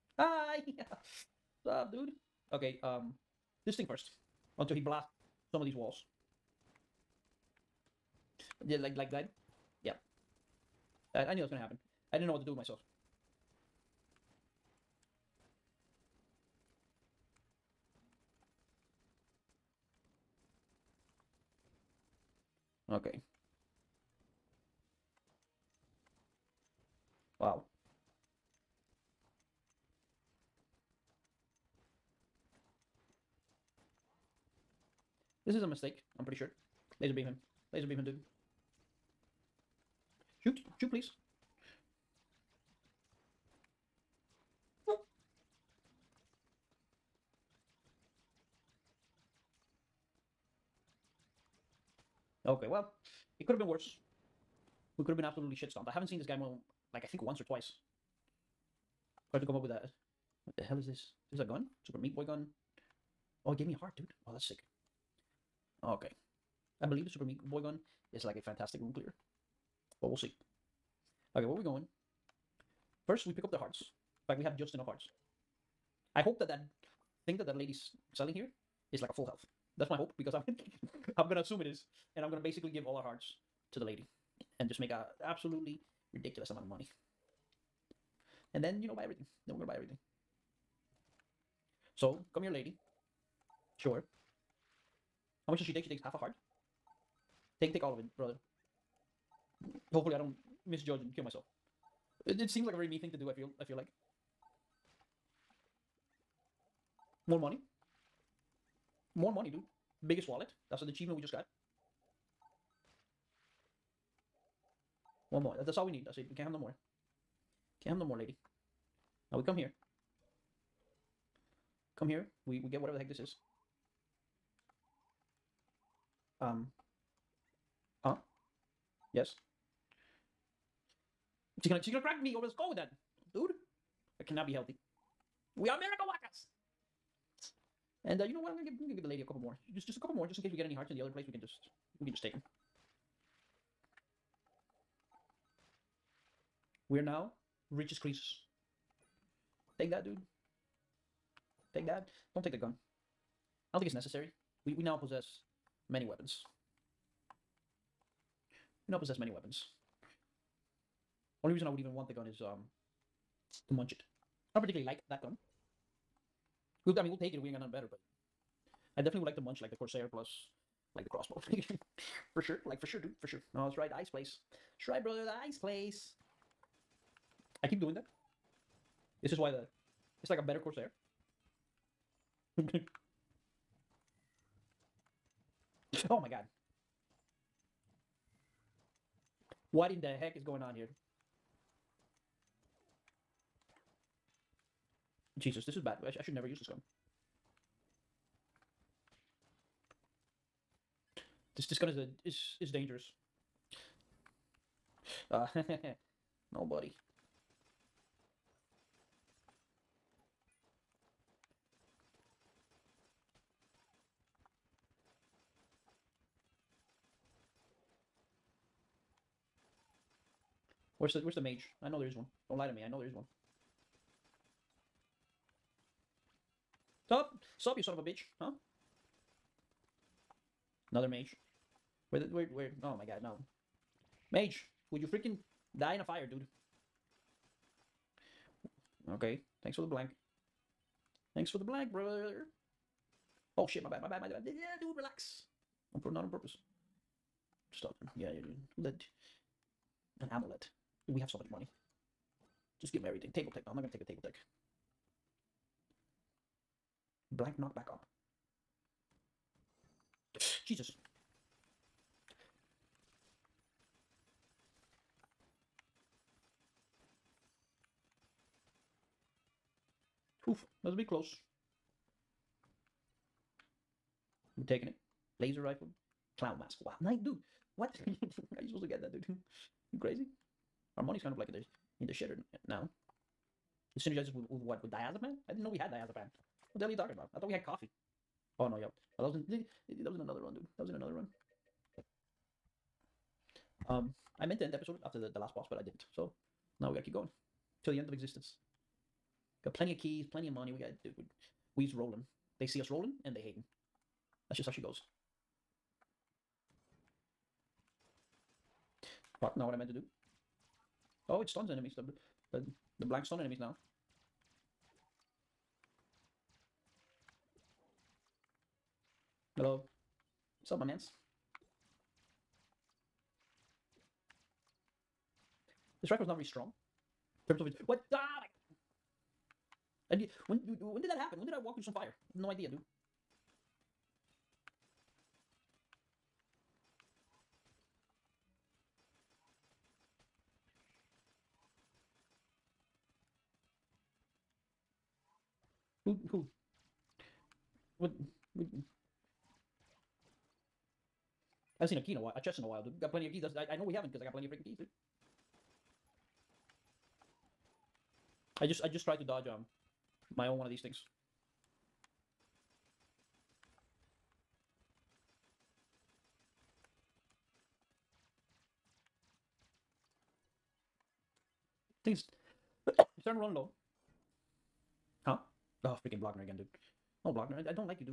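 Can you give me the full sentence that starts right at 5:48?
would I haven't seen a key in a while, a chest in a while, dude.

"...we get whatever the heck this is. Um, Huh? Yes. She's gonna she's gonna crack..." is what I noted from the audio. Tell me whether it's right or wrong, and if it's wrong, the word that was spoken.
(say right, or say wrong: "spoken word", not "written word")
right.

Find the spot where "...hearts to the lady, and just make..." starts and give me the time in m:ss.
1:23.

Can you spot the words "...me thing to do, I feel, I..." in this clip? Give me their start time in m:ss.
1:42.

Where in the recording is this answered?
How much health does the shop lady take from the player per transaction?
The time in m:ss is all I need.
1:36.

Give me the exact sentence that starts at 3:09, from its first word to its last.
What in the heck is going on here?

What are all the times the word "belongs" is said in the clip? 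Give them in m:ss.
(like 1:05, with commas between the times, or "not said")
not said.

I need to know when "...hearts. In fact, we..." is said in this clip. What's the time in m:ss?
1:13.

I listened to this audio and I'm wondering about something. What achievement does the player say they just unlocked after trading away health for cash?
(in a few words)
Biggest wallet.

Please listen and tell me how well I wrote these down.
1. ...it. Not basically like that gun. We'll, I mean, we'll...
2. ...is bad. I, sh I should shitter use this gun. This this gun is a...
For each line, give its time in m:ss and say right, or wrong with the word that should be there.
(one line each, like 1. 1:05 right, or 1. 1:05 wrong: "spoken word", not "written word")
1. 2:43 wrong: "particularly", not "basically"
2. 3:15 wrong: "never", not "shitter".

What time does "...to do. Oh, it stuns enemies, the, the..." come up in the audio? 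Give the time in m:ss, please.
5:09.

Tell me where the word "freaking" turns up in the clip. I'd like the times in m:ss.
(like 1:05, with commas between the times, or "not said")
3:55, 5:54, 6:16.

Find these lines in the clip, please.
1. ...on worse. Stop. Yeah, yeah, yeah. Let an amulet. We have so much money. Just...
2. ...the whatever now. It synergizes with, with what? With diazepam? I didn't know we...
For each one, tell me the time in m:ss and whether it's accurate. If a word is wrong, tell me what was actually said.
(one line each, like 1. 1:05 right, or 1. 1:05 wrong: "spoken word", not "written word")
1. 4:06 wrong: "purpose", not "worse"
2. 4:42 wrong: "shitter", not "whatever".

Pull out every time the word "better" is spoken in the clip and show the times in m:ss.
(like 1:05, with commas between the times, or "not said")
2:47, 3:00.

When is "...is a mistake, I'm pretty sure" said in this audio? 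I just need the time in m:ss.
0:35.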